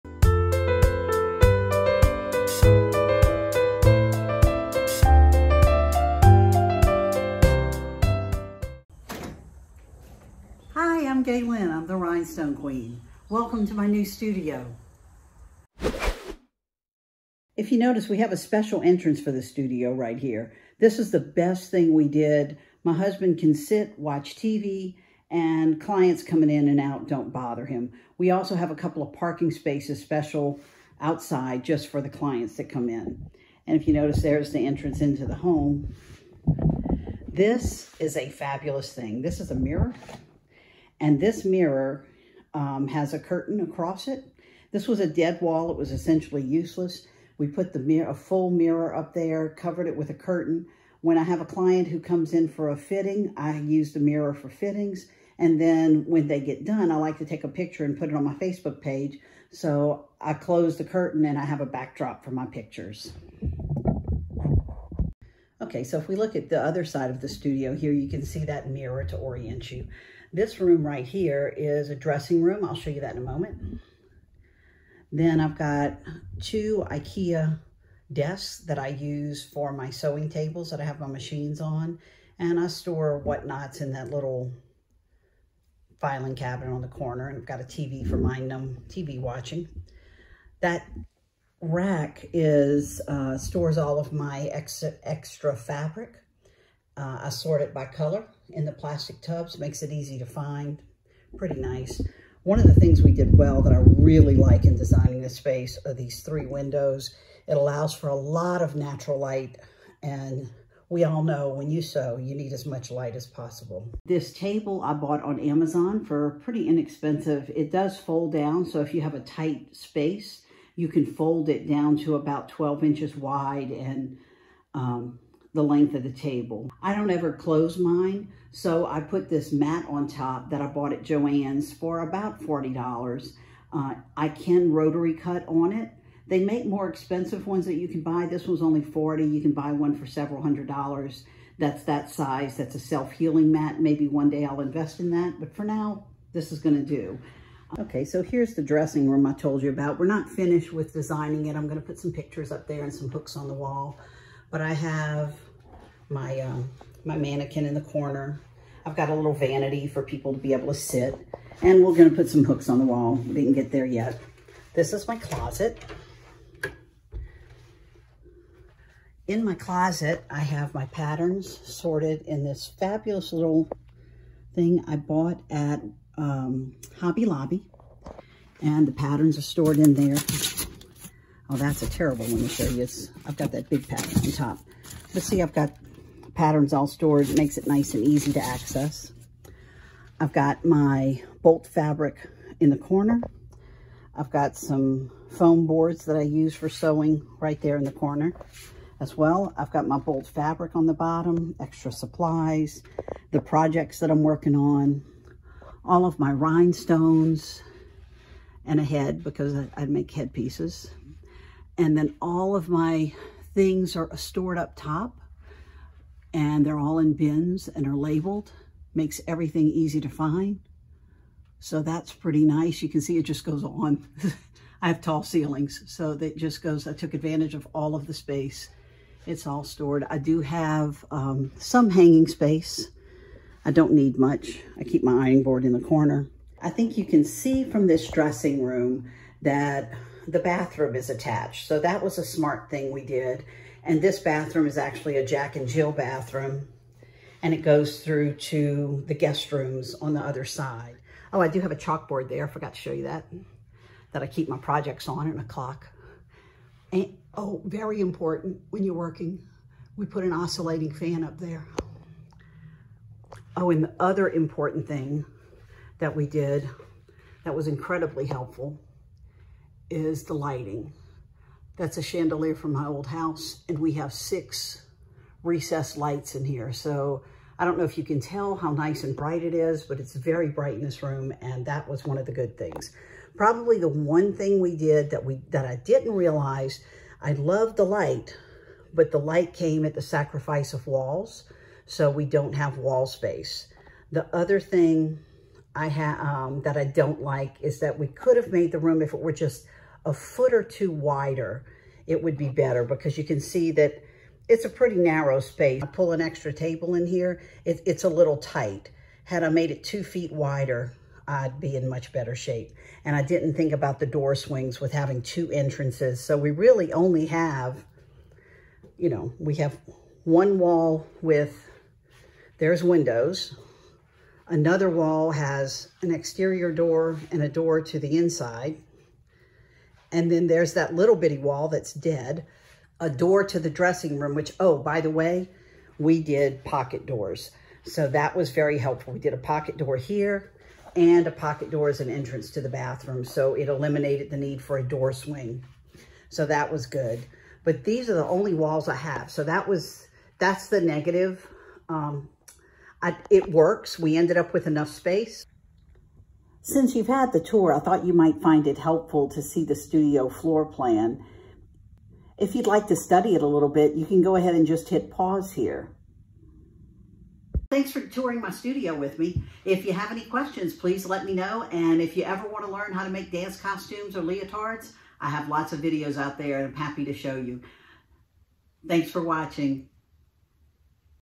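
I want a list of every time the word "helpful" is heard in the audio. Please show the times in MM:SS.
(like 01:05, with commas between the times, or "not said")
04:28, 05:38, 05:58.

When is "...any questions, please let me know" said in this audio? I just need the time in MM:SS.
06:10.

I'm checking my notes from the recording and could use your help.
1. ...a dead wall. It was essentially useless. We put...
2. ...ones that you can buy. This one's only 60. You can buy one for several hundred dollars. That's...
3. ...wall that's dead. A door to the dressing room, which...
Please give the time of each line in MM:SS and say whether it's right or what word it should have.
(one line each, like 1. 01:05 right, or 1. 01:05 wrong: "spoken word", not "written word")
1. 00:44 right
2. 02:17 wrong: "40", not "60"
3. 05:31 right.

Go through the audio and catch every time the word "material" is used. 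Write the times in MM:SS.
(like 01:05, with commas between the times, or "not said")
not said.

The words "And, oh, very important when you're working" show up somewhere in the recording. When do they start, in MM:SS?
04:16.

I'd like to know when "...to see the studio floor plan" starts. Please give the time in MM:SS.
05:59.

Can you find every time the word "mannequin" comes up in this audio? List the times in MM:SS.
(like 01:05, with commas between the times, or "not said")
02:37.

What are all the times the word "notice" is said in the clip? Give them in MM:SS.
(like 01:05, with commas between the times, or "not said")
00:17, 00:33.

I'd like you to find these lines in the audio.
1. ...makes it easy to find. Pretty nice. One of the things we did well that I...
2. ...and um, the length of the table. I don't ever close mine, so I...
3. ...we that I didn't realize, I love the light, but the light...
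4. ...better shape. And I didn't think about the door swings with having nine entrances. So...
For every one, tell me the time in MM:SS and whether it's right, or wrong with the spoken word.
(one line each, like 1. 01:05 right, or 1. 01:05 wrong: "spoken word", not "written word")
1. 01:39 right
2. 02:03 right
3. 04:45 right
4. 05:12 wrong: "two", not "nine".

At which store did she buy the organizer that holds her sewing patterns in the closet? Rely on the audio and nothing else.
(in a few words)
Hobby Lobby.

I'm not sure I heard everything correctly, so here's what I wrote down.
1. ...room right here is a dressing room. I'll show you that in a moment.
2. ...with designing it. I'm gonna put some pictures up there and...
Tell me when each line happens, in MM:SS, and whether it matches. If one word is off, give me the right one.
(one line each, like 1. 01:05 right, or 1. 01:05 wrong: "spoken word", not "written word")
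1. 01:10 right
2. 02:30 right.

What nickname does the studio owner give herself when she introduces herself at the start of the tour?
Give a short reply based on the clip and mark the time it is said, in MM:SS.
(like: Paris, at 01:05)
The Rhinestone Queen, at 00:11.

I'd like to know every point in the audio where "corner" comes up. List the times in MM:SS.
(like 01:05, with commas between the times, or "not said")
01:26, 02:37, 03:12, 03:17, 03:55.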